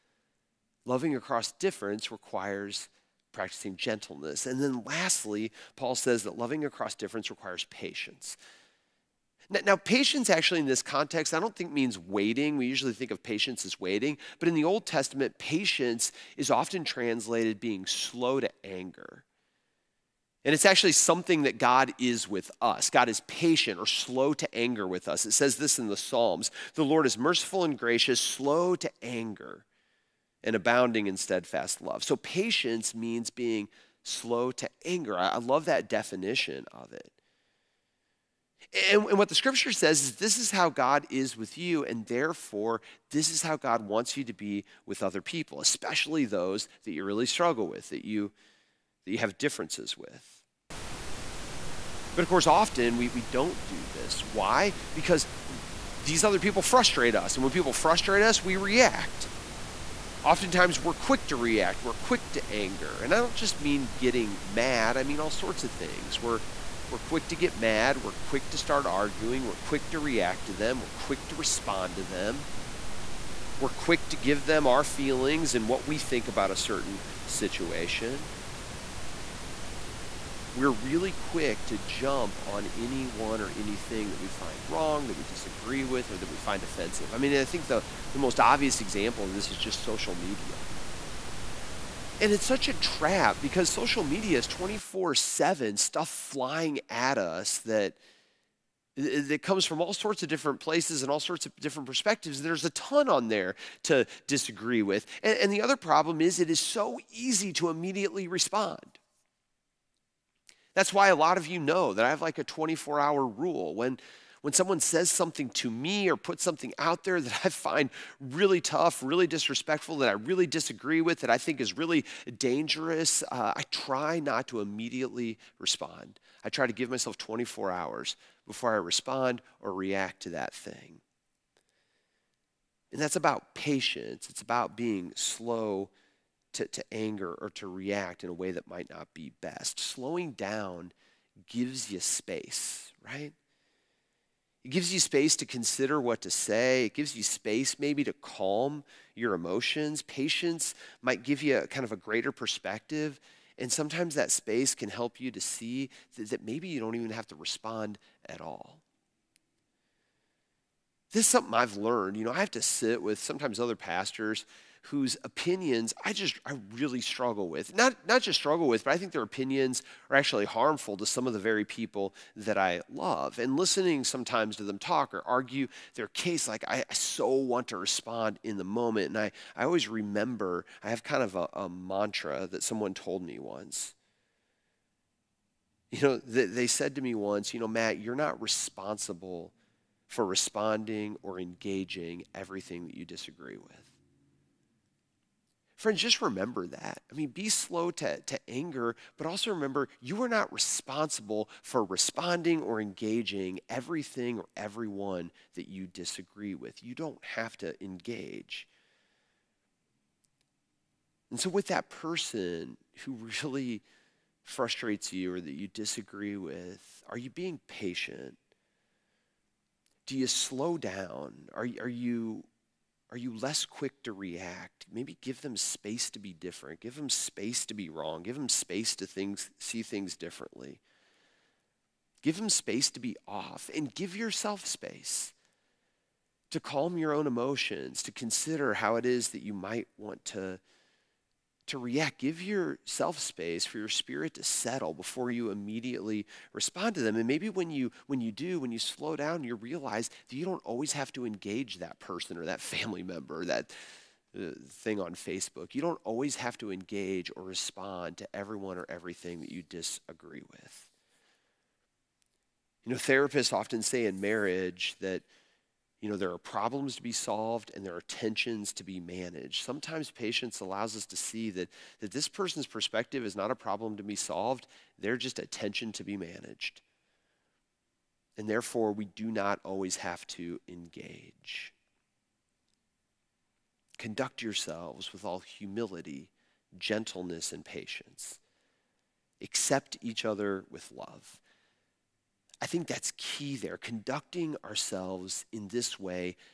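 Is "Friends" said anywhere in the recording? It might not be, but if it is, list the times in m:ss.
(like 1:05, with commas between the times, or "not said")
3:15.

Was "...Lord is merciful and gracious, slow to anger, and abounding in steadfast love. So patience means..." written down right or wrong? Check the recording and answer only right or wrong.
right.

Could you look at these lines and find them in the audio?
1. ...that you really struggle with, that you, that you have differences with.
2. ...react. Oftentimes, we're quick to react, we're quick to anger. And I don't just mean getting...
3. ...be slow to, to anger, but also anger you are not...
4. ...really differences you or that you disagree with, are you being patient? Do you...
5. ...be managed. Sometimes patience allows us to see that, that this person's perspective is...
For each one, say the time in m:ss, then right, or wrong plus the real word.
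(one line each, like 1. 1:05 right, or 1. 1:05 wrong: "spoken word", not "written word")
1. 0:46 right
2. 0:58 right
3. 3:17 wrong: "remember", not "anger"
4. 3:33 wrong: "frustrates", not "differences"
5. 4:28 right.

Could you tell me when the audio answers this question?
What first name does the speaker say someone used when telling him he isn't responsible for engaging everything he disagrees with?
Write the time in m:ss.
3:07.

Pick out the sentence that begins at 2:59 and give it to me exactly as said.
And I, I always remember I have kind of a, a mantra that someone told me once.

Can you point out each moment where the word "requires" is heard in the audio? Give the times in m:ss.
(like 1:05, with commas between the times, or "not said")
0:02, 0:07.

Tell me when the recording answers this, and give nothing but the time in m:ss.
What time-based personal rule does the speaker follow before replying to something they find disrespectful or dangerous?
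1:52.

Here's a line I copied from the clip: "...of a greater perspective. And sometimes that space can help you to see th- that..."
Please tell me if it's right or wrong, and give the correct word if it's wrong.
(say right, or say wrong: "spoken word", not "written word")
right.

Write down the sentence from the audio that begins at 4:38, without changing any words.
And therefore, we do not always have to engage.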